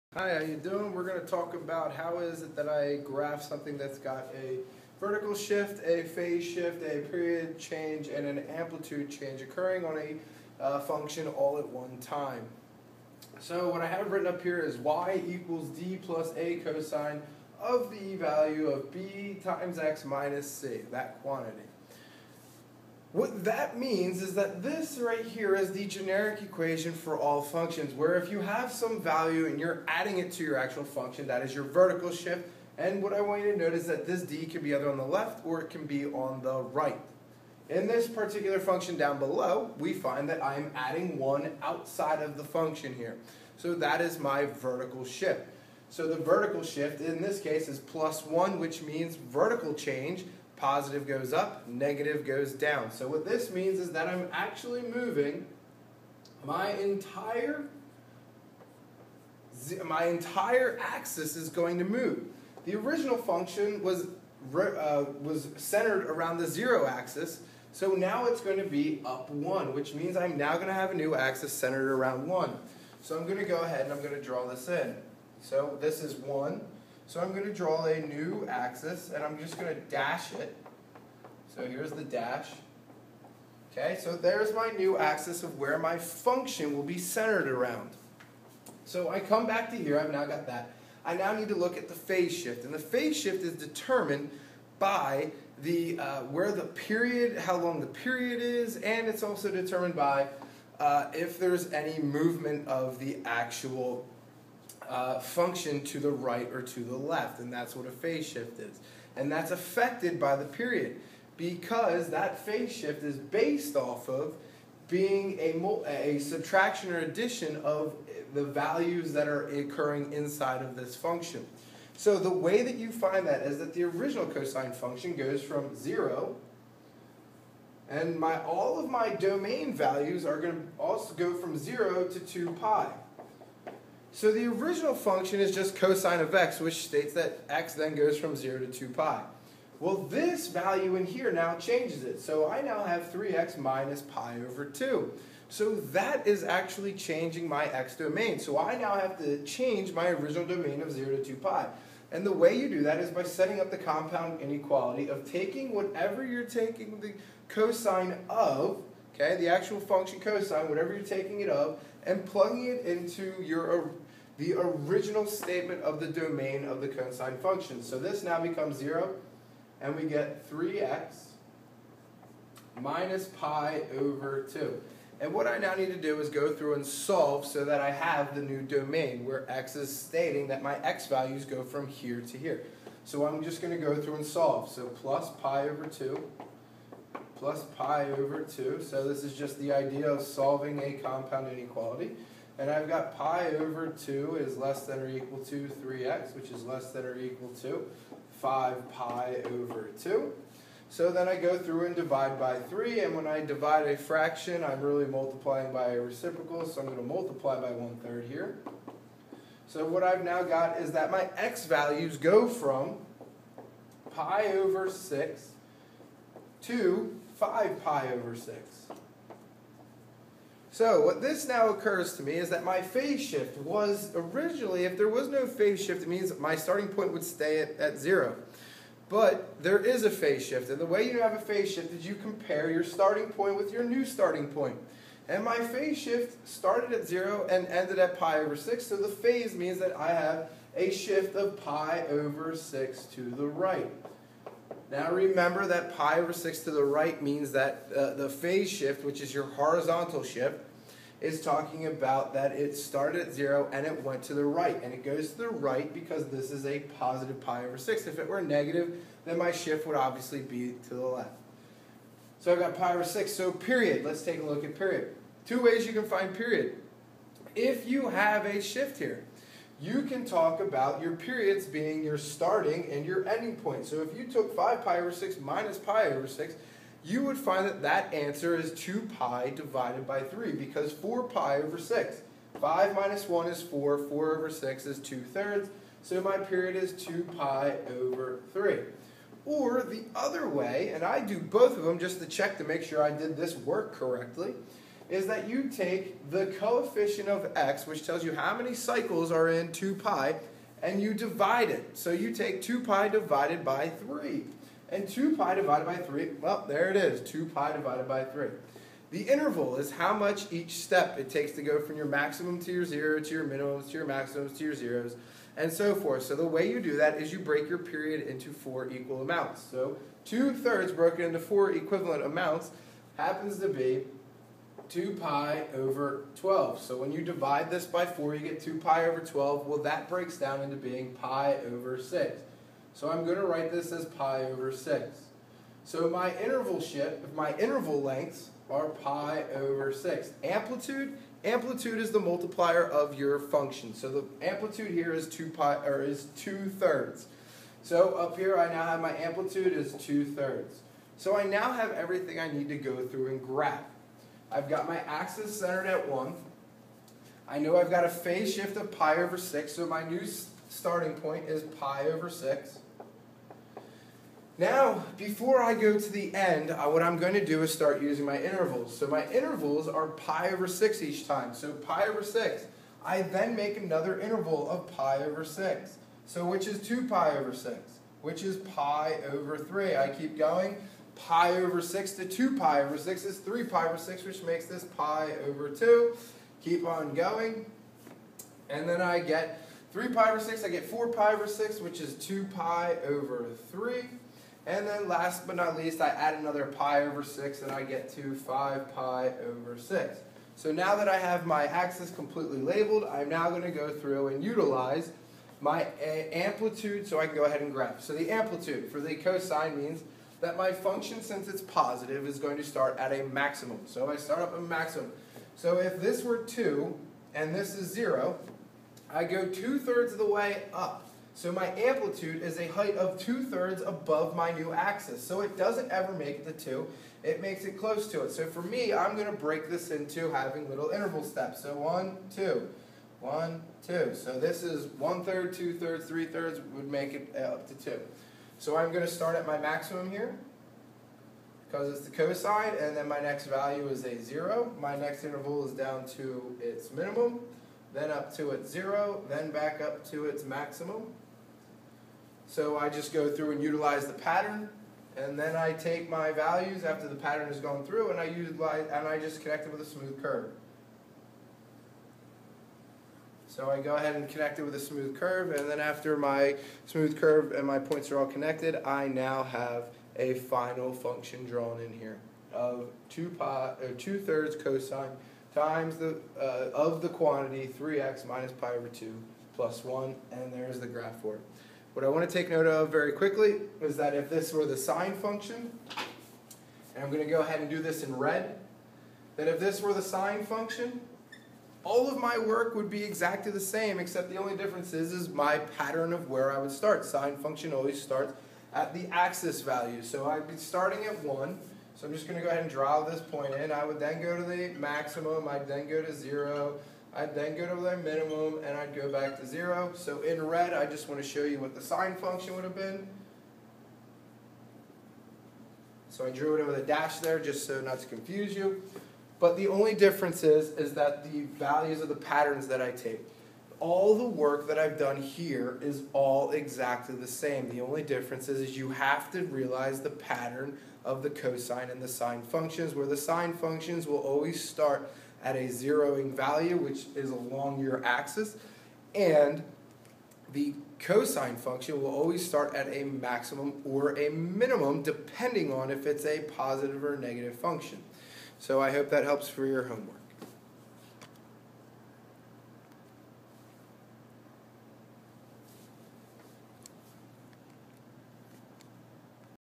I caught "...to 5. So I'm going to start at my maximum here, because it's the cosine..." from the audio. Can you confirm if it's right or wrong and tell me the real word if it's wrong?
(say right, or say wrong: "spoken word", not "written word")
wrong: "2", not "5".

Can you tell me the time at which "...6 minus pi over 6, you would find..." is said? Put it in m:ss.
4:35.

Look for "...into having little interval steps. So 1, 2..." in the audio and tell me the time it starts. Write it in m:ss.
7:09.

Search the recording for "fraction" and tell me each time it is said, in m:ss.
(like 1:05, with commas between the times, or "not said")
3:23.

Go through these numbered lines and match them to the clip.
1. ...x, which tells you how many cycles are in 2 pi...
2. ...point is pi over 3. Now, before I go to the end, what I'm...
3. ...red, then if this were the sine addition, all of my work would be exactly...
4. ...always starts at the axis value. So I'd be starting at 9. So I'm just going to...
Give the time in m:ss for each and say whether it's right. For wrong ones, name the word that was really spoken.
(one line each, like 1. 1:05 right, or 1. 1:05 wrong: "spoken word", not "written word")
1. 4:57 right
2. 6:01 wrong: "6", not "3"
3. 8:08 wrong: "function", not "addition"
4. 8:17 wrong: "1", not "9".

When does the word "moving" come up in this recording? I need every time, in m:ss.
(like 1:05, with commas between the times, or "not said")
0:54.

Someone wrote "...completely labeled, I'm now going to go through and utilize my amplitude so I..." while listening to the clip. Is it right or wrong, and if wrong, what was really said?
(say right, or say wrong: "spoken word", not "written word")
right.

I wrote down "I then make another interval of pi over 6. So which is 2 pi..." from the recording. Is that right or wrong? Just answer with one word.
right.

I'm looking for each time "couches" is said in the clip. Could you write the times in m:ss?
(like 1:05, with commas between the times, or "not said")
not said.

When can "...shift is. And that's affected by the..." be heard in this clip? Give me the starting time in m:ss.
1:48.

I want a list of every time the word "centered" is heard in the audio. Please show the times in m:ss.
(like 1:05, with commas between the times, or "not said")
1:05, 1:11, 1:26, 5:55.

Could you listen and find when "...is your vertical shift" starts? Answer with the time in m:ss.
0:31.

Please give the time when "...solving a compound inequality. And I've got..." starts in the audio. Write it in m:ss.
3:10.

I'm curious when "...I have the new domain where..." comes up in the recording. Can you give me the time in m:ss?
2:57.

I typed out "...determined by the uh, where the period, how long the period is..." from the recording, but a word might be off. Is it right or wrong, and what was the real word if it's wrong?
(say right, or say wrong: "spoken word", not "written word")
right.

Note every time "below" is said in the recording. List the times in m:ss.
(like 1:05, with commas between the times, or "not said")
0:39.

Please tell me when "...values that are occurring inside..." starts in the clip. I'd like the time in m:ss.
1:58.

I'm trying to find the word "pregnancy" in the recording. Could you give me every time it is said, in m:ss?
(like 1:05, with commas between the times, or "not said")
not said.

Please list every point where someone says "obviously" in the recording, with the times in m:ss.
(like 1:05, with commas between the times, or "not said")
4:19.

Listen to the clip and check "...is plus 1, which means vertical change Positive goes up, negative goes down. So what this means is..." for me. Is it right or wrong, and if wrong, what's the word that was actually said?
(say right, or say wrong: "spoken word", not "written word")
right.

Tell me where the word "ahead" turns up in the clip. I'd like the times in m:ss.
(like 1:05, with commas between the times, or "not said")
1:13, 6:47, 7:43, 8:07, 8:22.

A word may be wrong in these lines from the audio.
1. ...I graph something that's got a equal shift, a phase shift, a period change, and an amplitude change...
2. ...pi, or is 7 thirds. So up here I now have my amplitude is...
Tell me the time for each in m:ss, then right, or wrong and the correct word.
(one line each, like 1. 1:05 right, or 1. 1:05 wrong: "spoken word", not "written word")
1. 0:02 wrong: "vertical", not "equal"
2. 5:45 wrong: "2", not "7".